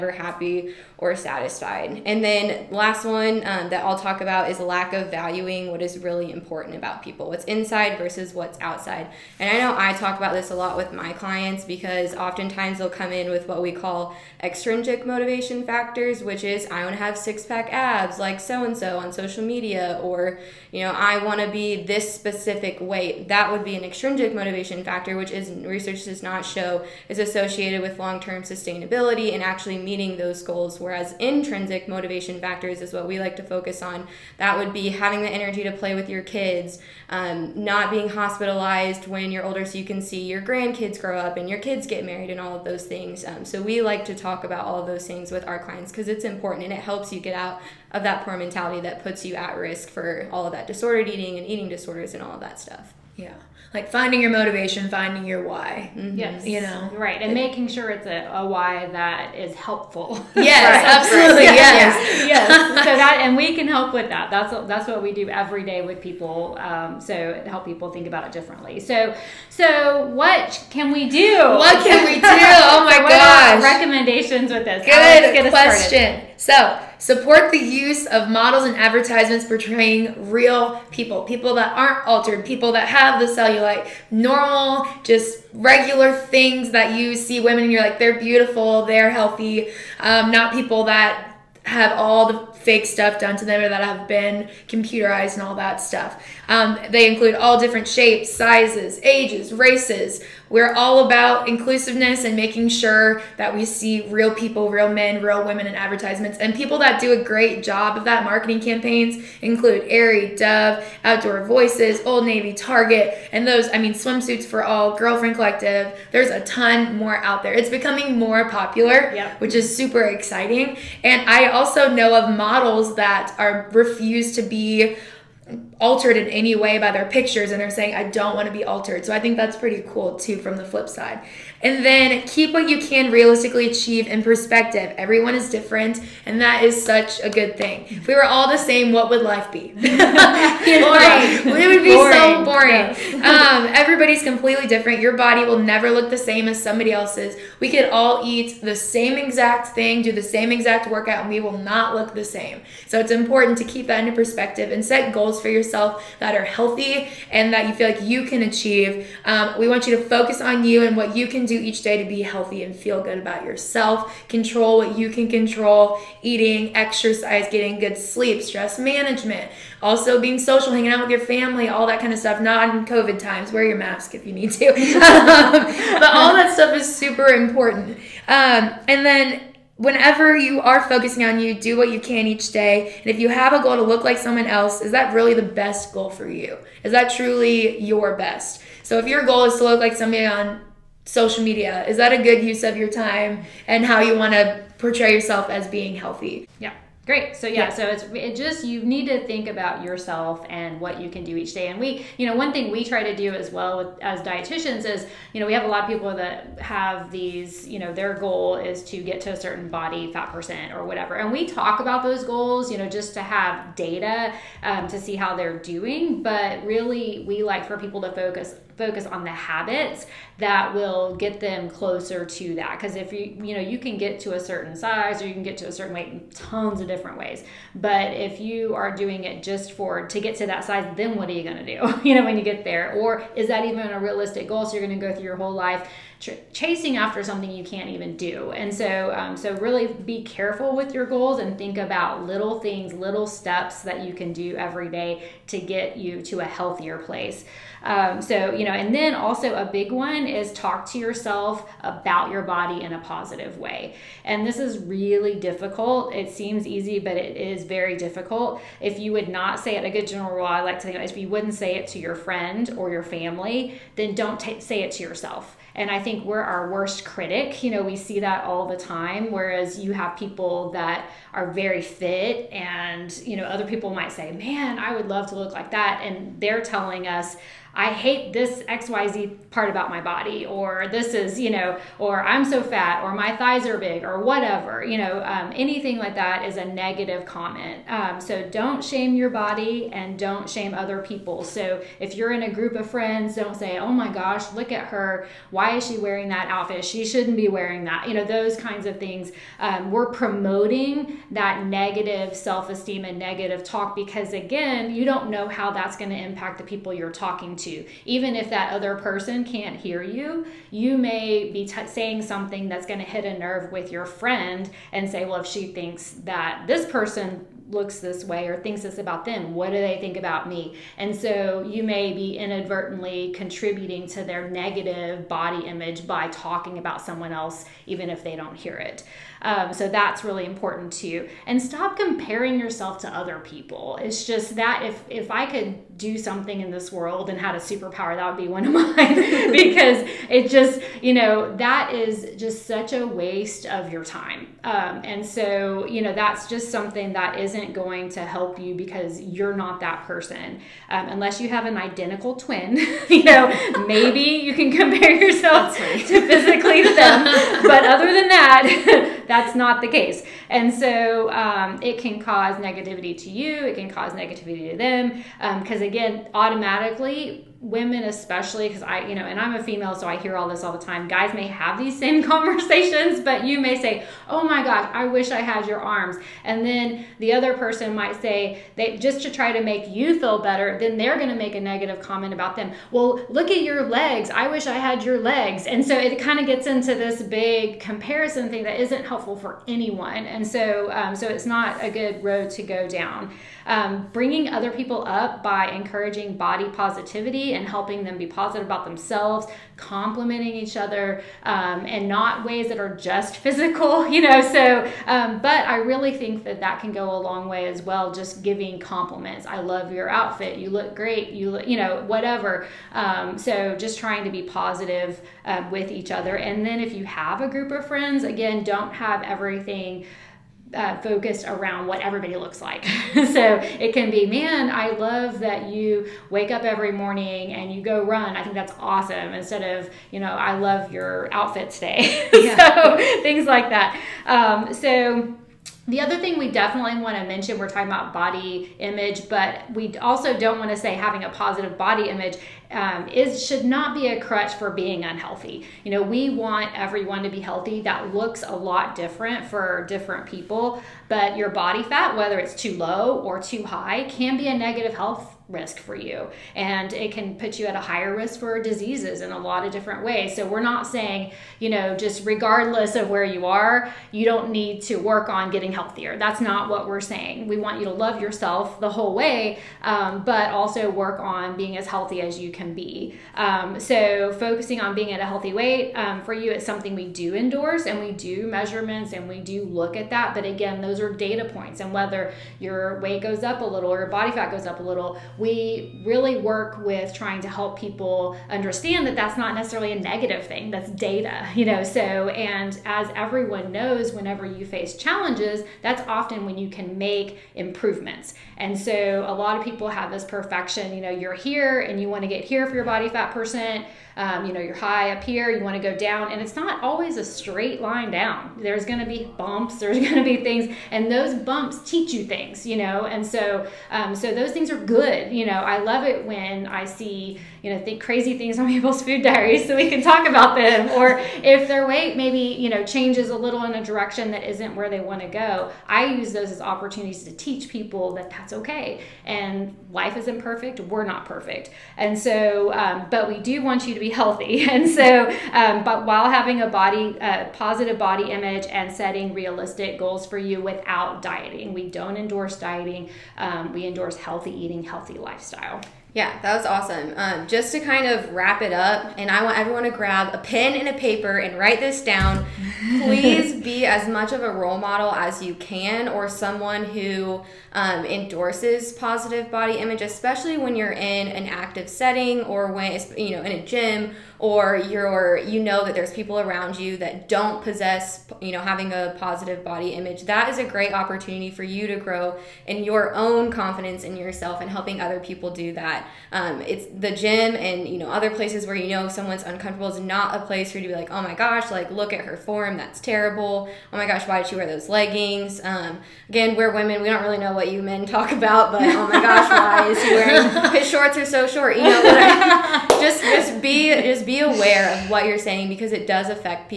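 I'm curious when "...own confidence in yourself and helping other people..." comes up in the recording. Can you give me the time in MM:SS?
09:33.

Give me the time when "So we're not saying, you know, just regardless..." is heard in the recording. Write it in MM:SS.
07:40.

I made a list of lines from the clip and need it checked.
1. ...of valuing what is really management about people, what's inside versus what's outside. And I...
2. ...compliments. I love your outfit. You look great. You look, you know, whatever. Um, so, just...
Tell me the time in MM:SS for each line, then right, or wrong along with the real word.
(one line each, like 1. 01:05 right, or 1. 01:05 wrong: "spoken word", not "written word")
1. 00:04 wrong: "important", not "management"
2. 06:48 right.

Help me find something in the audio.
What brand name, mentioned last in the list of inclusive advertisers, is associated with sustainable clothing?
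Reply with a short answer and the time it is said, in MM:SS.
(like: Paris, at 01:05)
Girlfriend Collective, at 01:54.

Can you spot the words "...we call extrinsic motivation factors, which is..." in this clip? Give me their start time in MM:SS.
00:13.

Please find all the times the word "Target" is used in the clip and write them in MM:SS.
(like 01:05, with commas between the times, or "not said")
01:52.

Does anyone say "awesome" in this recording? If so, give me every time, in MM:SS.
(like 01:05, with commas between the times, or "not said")
07:08, 09:06.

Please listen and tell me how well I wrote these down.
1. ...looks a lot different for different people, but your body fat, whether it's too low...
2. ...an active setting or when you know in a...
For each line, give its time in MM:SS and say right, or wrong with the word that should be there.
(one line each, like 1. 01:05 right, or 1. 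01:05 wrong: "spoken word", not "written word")
1. 07:28 right
2. 09:21 right.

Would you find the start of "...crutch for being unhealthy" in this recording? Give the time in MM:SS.
07:24.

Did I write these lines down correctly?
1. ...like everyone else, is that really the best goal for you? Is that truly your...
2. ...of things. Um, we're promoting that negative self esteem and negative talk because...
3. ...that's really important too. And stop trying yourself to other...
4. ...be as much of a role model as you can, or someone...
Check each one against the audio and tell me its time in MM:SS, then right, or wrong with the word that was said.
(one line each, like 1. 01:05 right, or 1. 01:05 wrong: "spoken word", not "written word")
1. 03:04 wrong: "someone", not "everyone"
2. 04:58 right
3. 05:29 wrong: "comparing", not "trying"
4. 09:13 right.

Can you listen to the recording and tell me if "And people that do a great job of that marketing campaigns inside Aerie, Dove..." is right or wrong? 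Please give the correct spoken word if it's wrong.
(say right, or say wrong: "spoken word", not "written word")
wrong: "include", not "inside".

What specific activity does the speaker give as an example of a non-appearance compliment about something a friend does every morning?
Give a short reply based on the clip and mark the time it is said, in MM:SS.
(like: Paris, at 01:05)
go run, at 07:07.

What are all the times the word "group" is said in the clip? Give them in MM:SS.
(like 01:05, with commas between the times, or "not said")
04:52, 06:57.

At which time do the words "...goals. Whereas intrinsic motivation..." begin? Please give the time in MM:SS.
00:30.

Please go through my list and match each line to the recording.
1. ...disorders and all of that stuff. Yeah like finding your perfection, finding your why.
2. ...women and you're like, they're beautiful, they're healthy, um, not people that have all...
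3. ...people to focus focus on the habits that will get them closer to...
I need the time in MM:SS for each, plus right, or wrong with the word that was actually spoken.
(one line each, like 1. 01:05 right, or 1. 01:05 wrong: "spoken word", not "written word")
1. 00:51 wrong: "motivation", not "perfection"
2. 01:27 right
3. 03:37 right.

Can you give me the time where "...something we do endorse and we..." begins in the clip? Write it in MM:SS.
07:56.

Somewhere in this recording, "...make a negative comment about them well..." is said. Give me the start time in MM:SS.
06:21.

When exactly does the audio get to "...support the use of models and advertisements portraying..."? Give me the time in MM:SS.
01:16.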